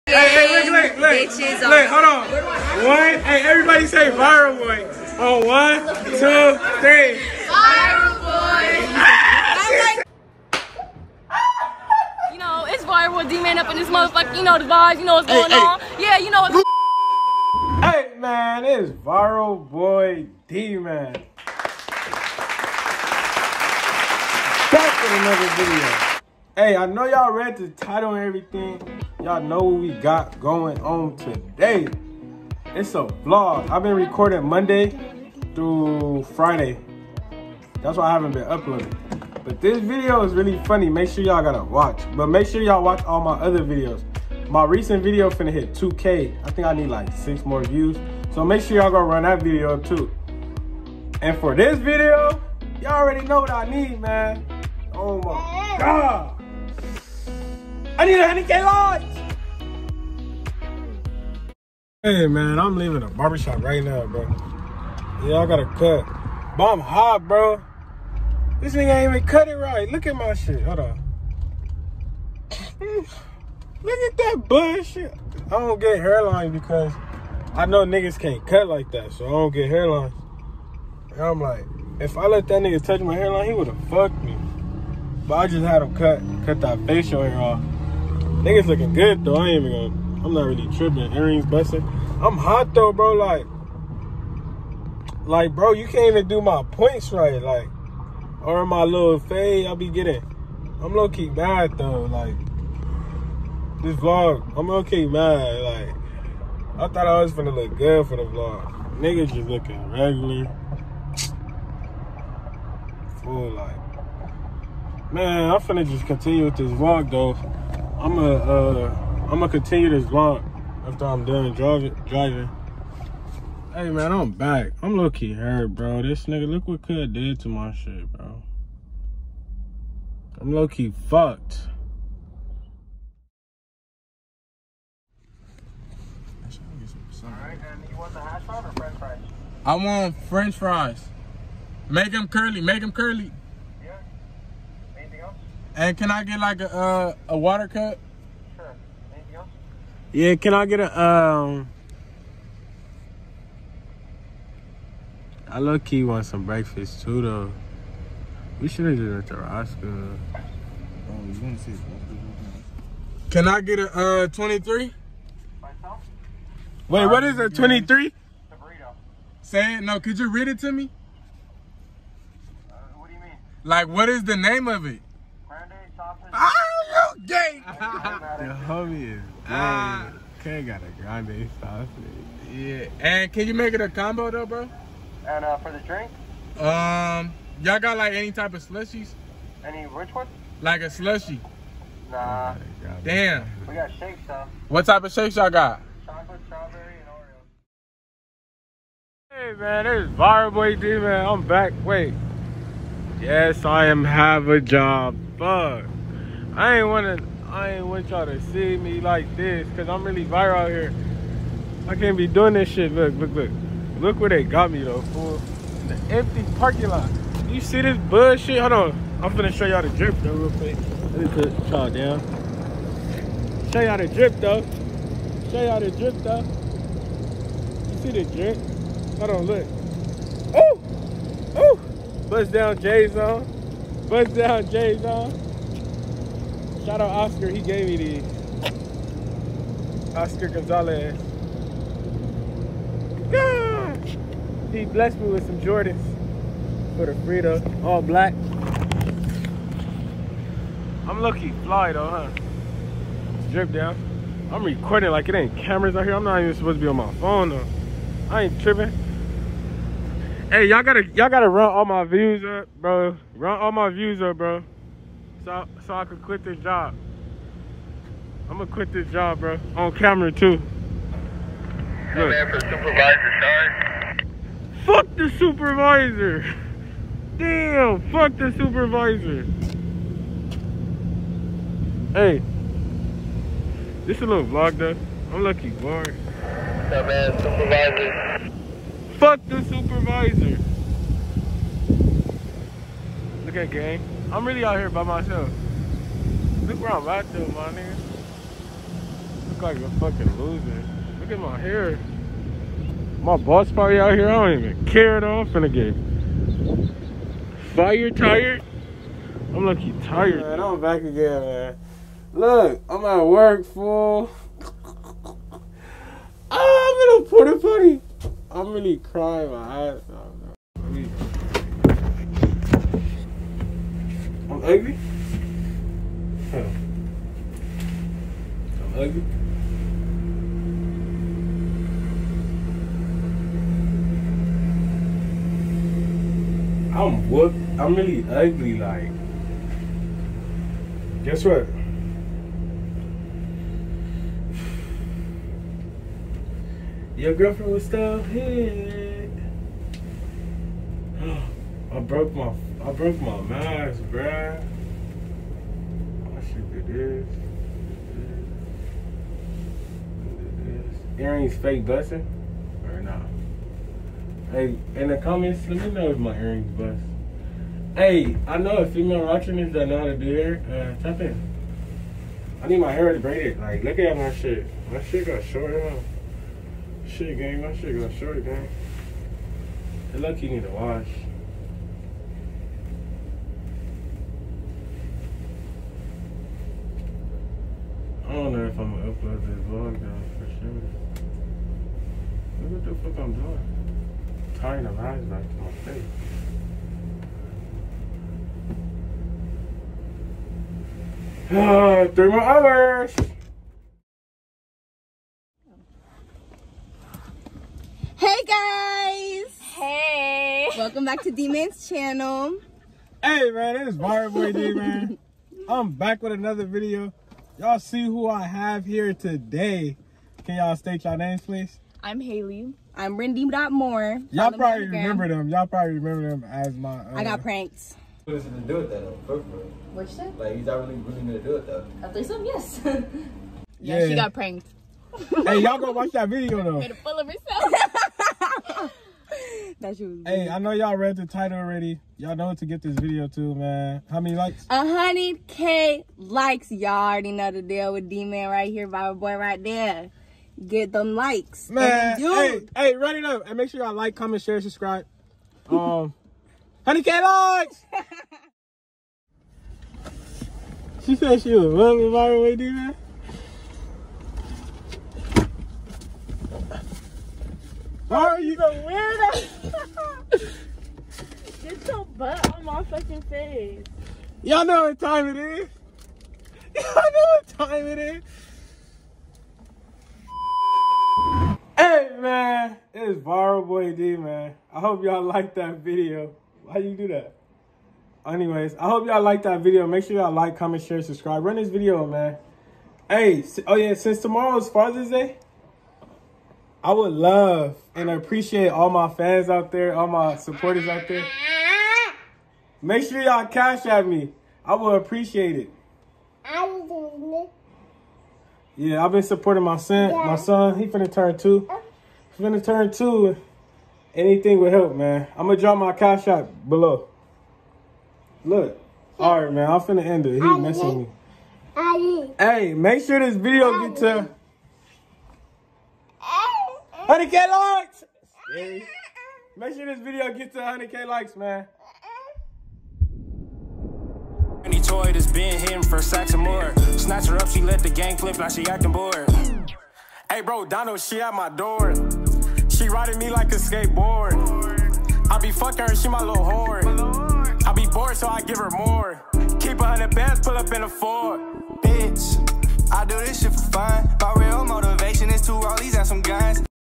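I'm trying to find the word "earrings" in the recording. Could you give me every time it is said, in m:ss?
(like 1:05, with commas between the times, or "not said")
1:31, 6:01, 6:06.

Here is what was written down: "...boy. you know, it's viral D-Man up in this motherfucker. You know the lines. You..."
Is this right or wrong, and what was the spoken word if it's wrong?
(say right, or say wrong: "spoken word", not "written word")
wrong: "vibes", not "lines".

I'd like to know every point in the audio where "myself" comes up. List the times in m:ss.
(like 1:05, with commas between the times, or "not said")
2:45, 4:55.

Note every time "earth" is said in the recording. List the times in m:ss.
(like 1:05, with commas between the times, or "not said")
not said.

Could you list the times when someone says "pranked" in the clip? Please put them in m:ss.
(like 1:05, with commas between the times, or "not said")
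7:07, 7:14.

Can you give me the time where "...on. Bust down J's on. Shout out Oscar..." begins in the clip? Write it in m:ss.
3:53.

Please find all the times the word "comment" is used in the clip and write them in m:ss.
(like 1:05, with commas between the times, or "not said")
6:05, 7:34, 8:10.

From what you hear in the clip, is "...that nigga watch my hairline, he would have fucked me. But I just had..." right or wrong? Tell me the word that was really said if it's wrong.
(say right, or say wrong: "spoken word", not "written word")
wrong: "touch", not "watch".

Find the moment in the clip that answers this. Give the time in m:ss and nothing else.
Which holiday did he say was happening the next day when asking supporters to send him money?
8:14.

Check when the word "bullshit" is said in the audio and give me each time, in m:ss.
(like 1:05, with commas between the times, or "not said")
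1:14, 3:37.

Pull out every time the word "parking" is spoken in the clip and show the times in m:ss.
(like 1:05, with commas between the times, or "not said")
3:36.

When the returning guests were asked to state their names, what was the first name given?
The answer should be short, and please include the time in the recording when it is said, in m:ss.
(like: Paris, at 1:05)
Haley, at 7:02.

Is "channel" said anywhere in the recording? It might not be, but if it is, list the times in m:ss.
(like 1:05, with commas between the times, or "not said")
6:51.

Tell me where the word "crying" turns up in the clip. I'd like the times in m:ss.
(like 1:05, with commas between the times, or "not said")
5:18.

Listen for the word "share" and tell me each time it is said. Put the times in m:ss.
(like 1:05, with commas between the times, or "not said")
7:34, 8:10.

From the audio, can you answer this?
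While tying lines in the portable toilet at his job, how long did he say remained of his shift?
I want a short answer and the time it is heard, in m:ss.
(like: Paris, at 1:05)
3 hours, at 6:42.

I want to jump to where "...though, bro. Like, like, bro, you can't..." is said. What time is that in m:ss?
1:32.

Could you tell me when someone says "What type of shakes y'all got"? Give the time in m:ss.
3:14.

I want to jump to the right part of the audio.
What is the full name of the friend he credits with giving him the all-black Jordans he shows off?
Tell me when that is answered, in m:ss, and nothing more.
4:00.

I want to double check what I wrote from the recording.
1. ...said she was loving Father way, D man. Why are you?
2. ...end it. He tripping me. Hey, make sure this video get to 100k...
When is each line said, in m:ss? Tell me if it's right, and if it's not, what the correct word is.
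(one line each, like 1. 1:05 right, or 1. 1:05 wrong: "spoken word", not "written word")
1. 7:41 wrong: "Bible", not "Father"
2. 8:40 wrong: "messing", not "tripping".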